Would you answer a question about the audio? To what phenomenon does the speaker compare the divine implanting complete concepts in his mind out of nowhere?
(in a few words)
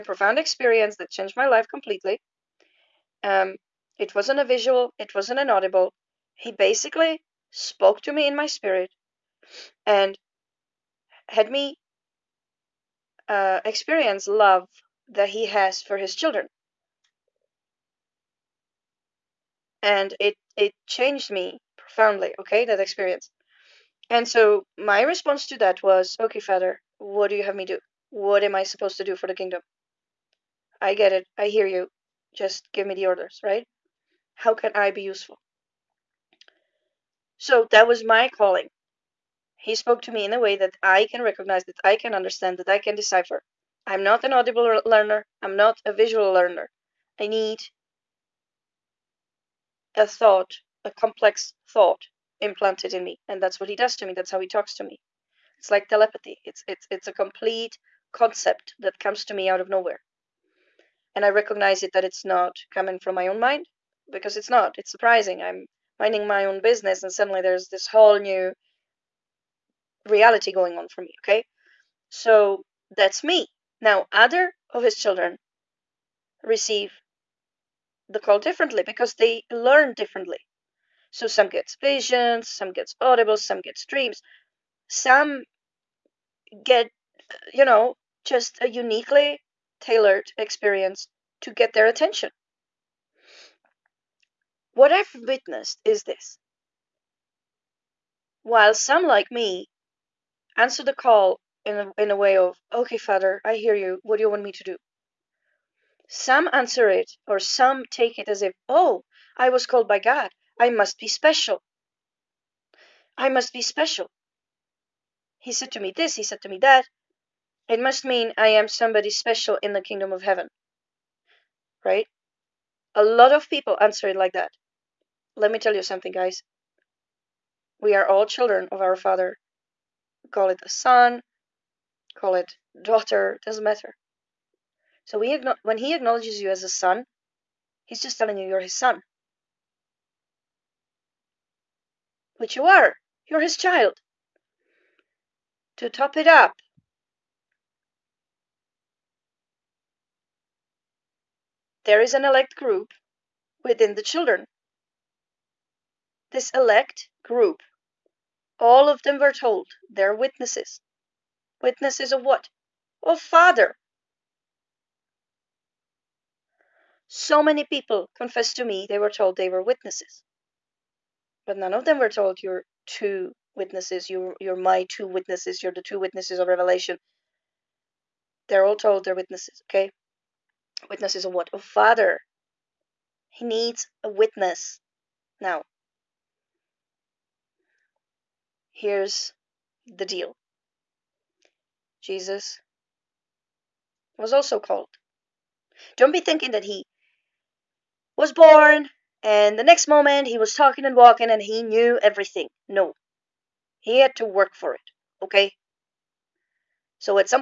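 Telepathy.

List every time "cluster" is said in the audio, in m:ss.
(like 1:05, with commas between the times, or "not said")
not said.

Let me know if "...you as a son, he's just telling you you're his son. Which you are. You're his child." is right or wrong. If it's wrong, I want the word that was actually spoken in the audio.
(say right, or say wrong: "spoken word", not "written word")
right.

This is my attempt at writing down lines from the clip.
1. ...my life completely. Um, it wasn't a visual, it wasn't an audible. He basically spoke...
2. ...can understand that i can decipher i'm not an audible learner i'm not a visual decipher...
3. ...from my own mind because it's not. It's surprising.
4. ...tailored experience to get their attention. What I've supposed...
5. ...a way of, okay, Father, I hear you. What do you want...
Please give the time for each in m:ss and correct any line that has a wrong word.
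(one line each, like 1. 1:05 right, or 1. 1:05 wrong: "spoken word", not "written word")
1. 0:01 right
2. 0:41 wrong: "learner", not "decipher"
3. 1:02 right
4. 1:29 wrong: "witnessed", not "supposed"
5. 1:42 right.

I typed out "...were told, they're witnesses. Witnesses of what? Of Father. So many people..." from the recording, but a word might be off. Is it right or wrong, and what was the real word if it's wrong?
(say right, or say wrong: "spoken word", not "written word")
right.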